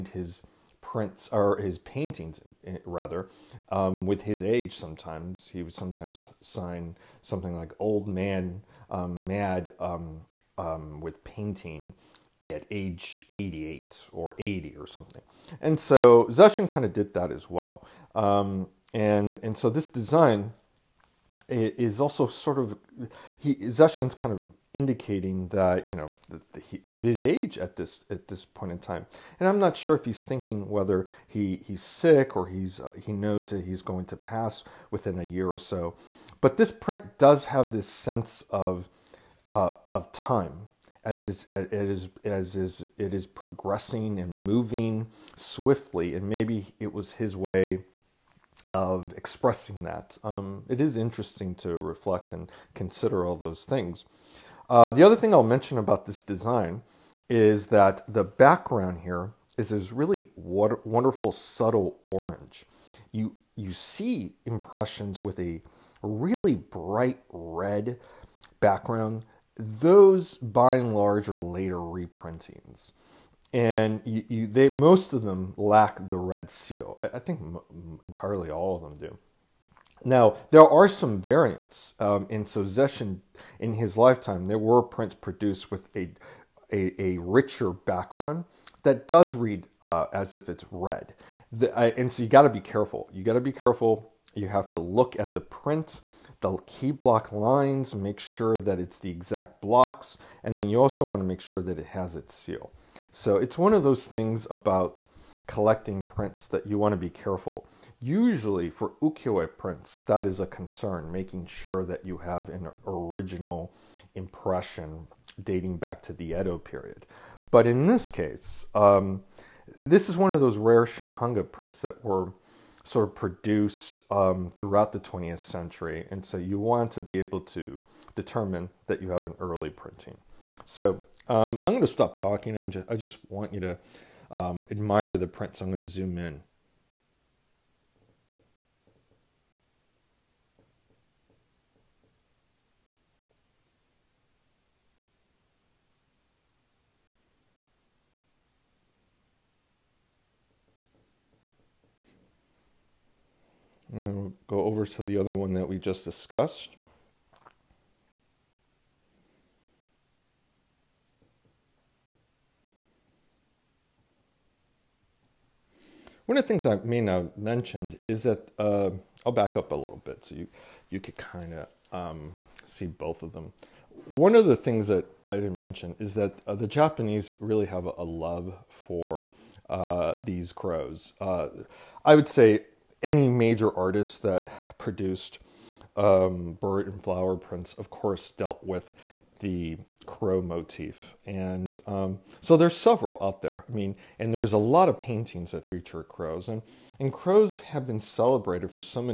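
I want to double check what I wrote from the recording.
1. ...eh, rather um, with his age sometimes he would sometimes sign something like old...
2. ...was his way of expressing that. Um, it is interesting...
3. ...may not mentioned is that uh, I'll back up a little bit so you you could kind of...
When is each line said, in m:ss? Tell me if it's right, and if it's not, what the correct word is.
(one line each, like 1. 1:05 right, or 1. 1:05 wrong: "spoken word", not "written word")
1. 0:02 right
2. 0:46 right
3. 2:46 right.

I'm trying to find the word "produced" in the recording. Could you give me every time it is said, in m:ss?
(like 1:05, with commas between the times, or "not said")
1:25, 2:03, 3:04.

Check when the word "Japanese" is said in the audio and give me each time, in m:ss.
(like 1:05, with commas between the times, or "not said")
2:56.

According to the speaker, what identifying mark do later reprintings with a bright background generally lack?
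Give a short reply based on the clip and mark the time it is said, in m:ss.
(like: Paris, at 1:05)
red seal, at 1:16.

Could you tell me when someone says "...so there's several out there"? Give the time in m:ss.
3:12.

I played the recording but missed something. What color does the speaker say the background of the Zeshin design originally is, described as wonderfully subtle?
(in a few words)
orange.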